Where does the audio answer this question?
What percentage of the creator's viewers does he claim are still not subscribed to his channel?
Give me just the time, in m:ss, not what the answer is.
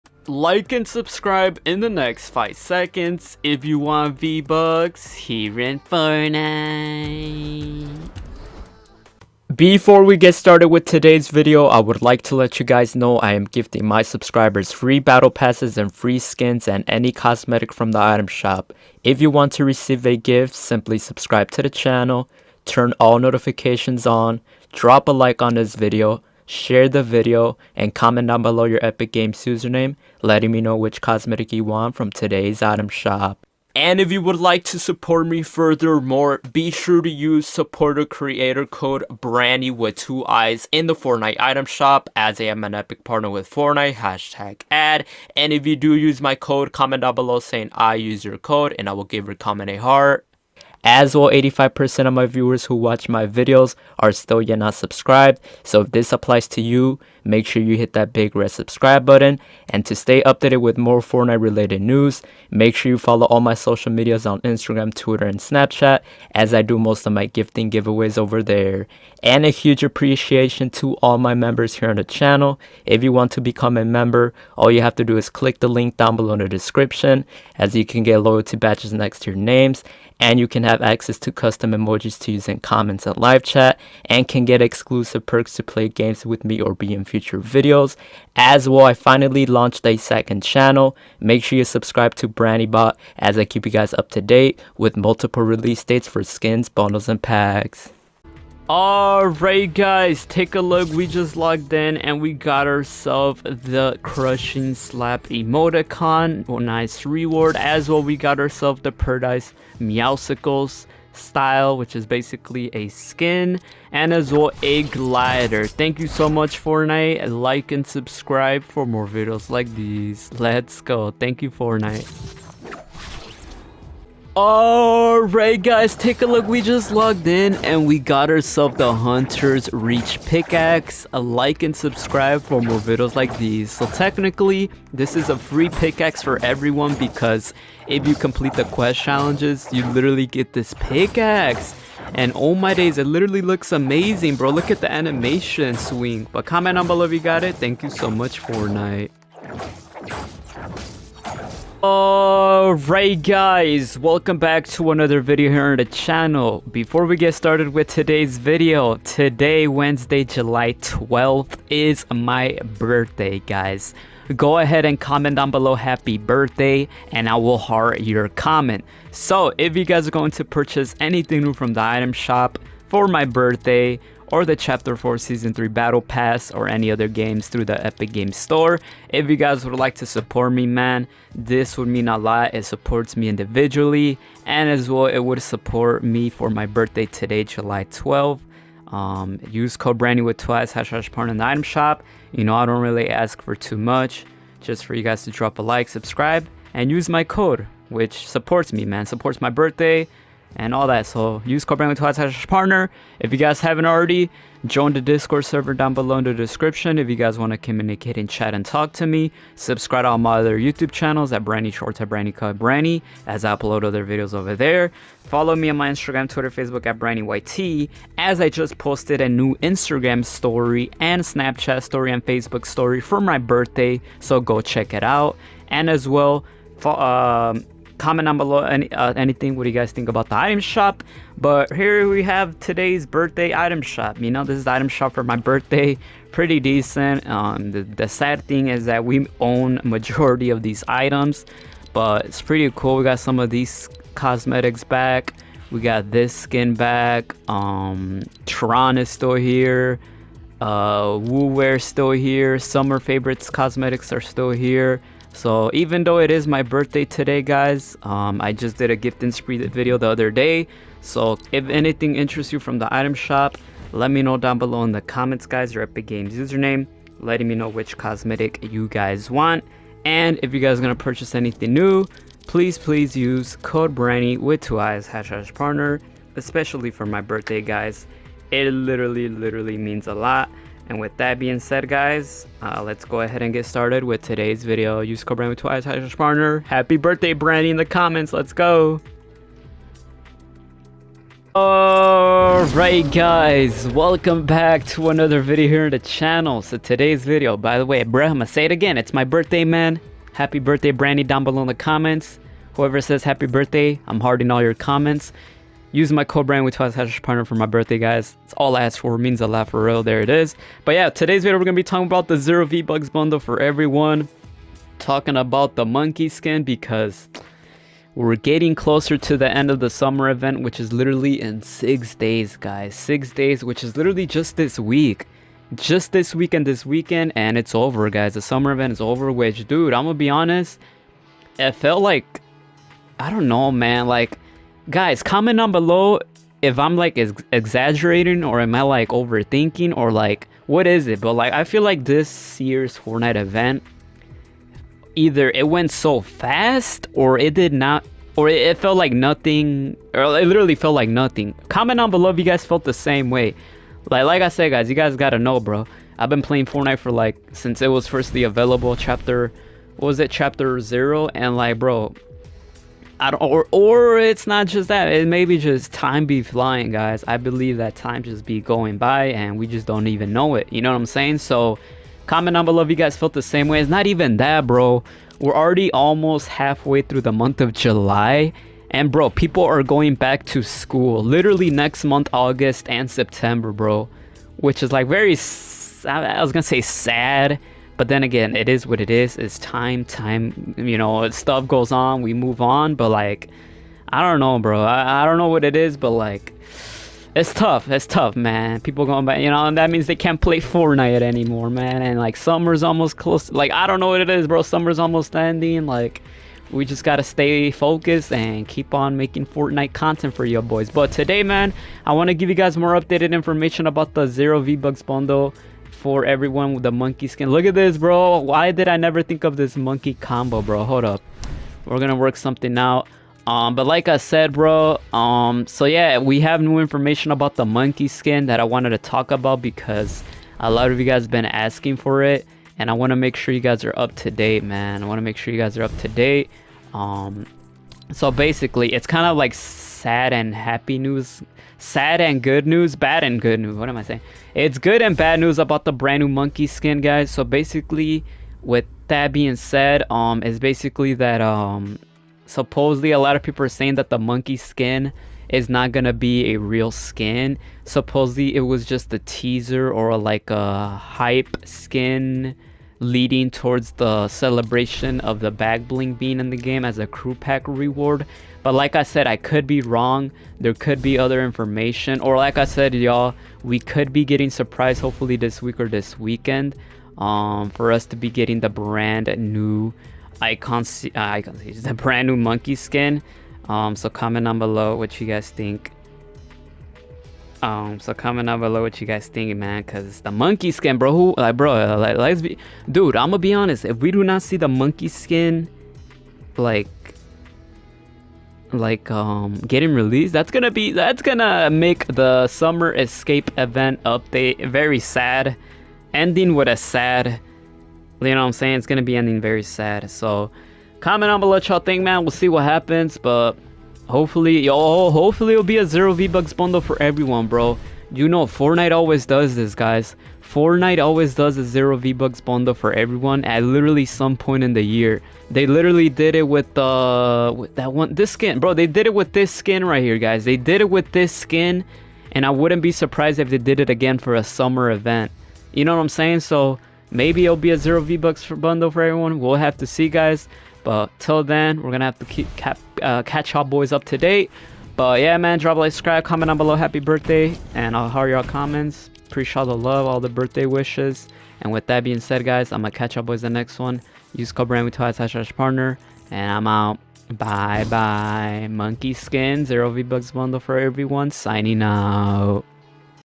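0:51.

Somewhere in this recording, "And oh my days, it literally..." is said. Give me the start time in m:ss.
2:22.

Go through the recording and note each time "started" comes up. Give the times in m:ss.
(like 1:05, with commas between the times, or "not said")
0:10, 2:37, 4:43.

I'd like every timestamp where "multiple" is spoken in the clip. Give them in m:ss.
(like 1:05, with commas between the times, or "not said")
1:34.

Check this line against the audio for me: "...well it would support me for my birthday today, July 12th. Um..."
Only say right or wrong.
right.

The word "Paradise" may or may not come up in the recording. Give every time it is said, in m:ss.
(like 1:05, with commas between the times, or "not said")
1:48.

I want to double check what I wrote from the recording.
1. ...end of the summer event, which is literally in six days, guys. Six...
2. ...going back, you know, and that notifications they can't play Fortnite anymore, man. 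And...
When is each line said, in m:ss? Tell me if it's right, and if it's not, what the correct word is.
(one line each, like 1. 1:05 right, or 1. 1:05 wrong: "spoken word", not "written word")
1. 5:19 right
2. 6:39 wrong: "means", not "notifications".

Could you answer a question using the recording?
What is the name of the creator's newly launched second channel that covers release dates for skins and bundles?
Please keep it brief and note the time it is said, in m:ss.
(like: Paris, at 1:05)
BraniBot, at 1:32.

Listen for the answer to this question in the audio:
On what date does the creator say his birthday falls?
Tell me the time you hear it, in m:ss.
2:39.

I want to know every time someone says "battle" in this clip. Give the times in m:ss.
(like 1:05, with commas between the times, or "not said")
0:14, 2:55.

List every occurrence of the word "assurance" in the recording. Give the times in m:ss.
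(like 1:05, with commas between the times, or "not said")
not said.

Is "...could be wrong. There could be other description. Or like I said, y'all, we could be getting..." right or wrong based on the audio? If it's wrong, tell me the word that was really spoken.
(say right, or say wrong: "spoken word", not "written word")
wrong: "information", not "description".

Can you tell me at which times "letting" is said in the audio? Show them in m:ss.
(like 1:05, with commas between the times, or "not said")
0:30, 4:27.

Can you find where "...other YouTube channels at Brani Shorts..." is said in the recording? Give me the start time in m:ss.
3:30.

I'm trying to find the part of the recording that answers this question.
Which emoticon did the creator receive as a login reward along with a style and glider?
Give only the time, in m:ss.
1:44.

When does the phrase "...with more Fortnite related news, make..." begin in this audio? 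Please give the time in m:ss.
1:00.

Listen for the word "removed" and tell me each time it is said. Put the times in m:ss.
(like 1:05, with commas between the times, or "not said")
not said.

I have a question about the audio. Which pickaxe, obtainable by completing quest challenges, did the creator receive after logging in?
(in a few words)
Hunter's Reach.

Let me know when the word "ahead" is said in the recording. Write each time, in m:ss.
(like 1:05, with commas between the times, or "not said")
2:44, 4:43.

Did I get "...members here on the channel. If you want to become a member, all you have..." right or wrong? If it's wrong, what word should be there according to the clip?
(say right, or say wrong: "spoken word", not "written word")
right.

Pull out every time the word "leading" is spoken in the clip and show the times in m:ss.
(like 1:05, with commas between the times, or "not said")
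7:43.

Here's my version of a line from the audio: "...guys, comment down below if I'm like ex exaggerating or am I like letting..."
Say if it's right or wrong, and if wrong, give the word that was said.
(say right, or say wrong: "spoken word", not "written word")
wrong: "overthinking", not "letting".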